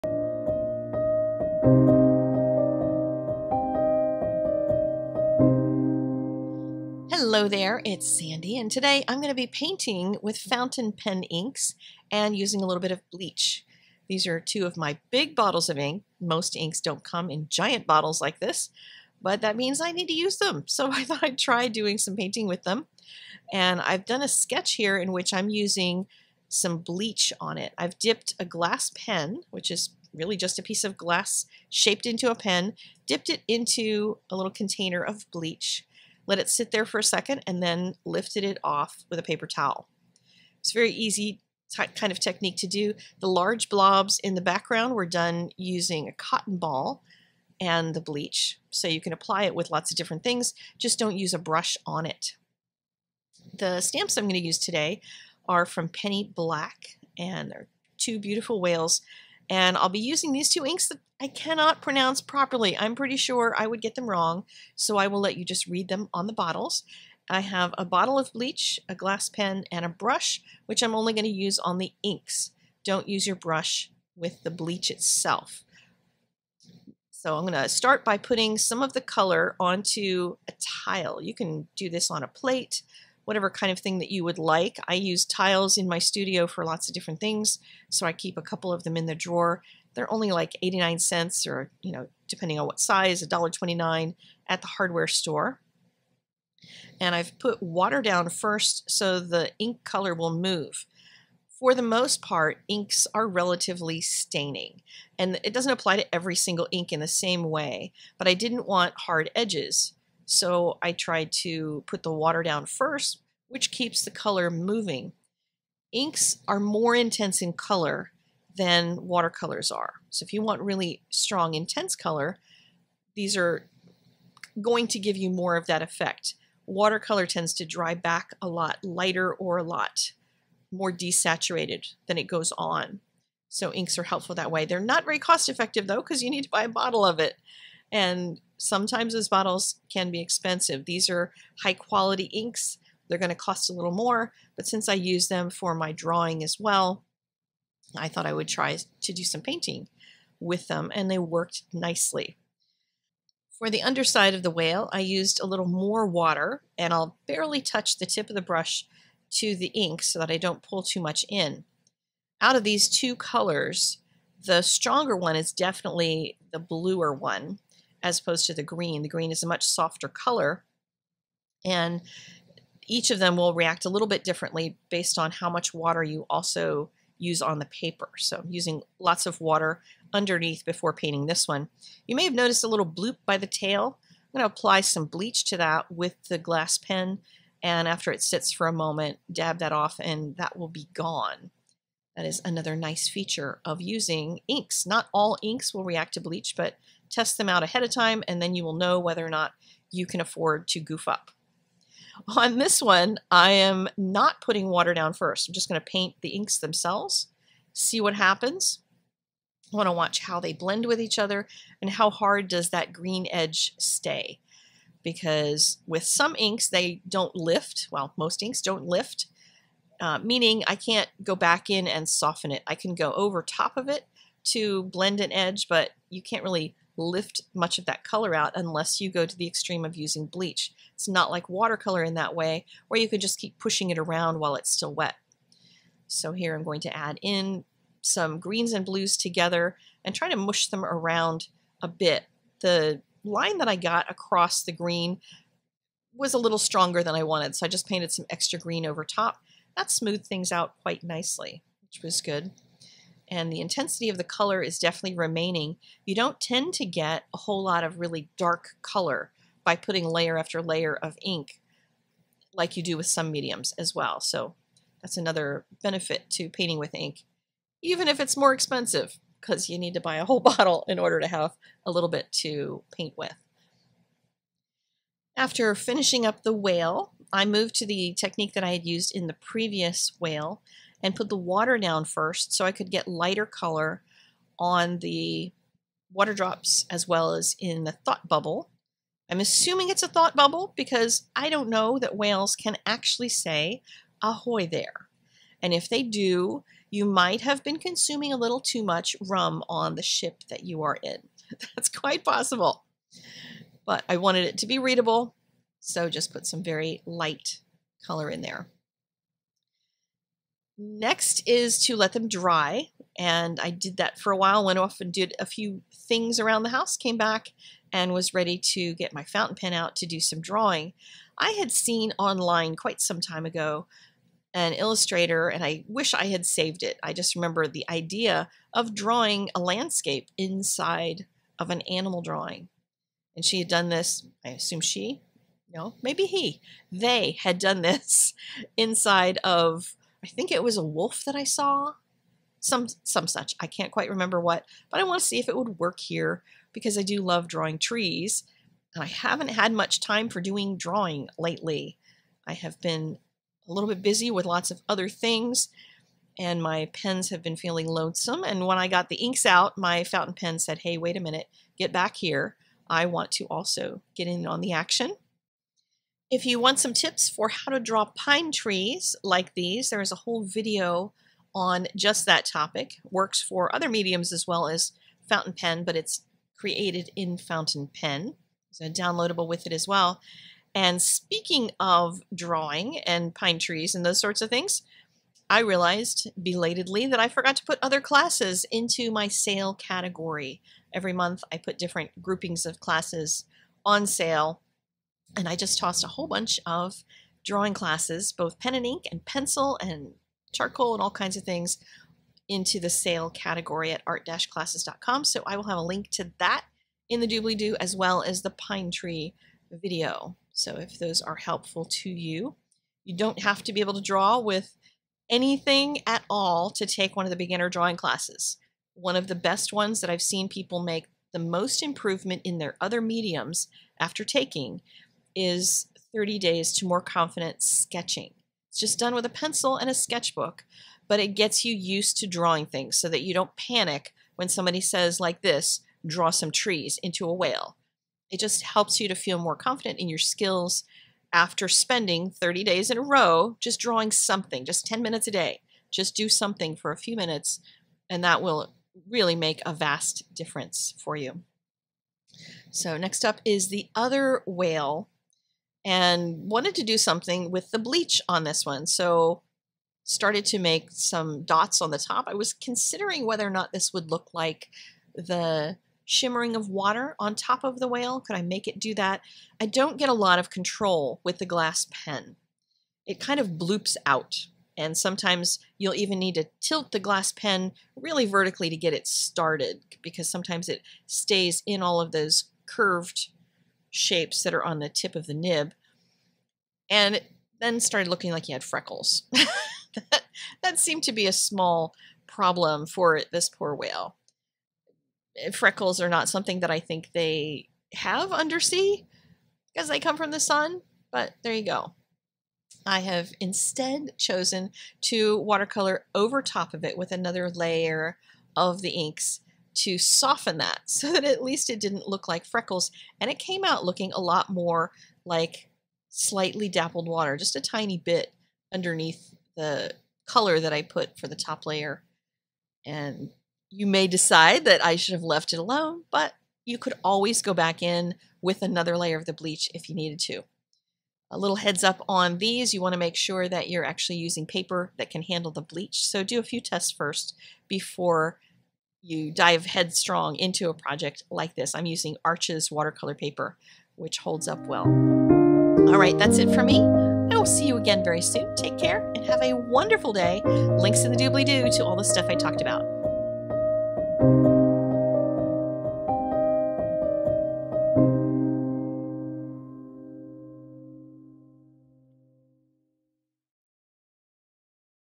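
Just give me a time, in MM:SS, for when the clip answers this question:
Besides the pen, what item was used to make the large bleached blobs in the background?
00:46.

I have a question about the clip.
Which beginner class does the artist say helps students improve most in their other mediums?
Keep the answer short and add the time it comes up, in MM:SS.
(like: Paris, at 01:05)
30 days to more confident sketching, at 07:06.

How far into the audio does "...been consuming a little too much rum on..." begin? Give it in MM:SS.
04:57.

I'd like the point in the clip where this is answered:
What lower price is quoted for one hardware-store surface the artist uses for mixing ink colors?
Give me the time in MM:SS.
01:30.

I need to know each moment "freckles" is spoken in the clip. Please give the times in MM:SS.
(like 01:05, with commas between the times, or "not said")
08:08, 08:15, 08:32.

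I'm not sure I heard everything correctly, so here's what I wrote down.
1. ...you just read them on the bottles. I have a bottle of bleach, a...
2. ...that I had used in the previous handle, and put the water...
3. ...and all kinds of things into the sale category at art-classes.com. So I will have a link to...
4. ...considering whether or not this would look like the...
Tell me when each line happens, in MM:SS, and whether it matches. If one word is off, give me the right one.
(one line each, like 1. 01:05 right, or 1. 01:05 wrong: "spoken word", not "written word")
1. 01:05 right
2. 04:38 wrong: "whale", not "handle"
3. 06:40 right
4. 07:42 right.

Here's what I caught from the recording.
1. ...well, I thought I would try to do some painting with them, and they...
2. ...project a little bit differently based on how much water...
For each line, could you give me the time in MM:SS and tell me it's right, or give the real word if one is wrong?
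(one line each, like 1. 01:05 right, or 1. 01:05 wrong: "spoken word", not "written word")
1. 02:26 right
2. 02:53 wrong: "react", not "project".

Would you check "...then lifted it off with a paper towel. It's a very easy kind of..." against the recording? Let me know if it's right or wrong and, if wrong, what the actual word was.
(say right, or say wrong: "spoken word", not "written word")
right.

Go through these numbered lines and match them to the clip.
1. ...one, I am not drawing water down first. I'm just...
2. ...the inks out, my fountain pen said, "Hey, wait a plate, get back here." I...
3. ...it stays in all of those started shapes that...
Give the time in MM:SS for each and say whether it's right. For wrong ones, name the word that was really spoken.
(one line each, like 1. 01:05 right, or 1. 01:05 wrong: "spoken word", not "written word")
1. 03:22 wrong: "putting", not "drawing"
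2. 05:59 wrong: "minute", not "plate"
3. 08:00 wrong: "curved", not "started".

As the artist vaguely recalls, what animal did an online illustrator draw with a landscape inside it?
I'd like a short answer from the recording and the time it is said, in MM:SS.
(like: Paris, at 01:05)
wolf, at 05:40.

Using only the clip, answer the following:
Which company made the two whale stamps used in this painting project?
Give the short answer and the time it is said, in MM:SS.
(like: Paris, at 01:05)
Penny Black, at 00:55.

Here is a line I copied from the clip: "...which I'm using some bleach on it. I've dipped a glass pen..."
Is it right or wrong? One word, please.
right.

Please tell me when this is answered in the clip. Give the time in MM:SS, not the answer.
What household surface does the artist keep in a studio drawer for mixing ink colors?
01:25.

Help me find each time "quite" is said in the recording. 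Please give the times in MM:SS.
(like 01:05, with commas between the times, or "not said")
04:10, 05:01, 05:22, 05:43.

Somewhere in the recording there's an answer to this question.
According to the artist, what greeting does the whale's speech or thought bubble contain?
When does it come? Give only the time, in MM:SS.
04:54.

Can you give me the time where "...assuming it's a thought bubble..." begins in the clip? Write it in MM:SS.
04:49.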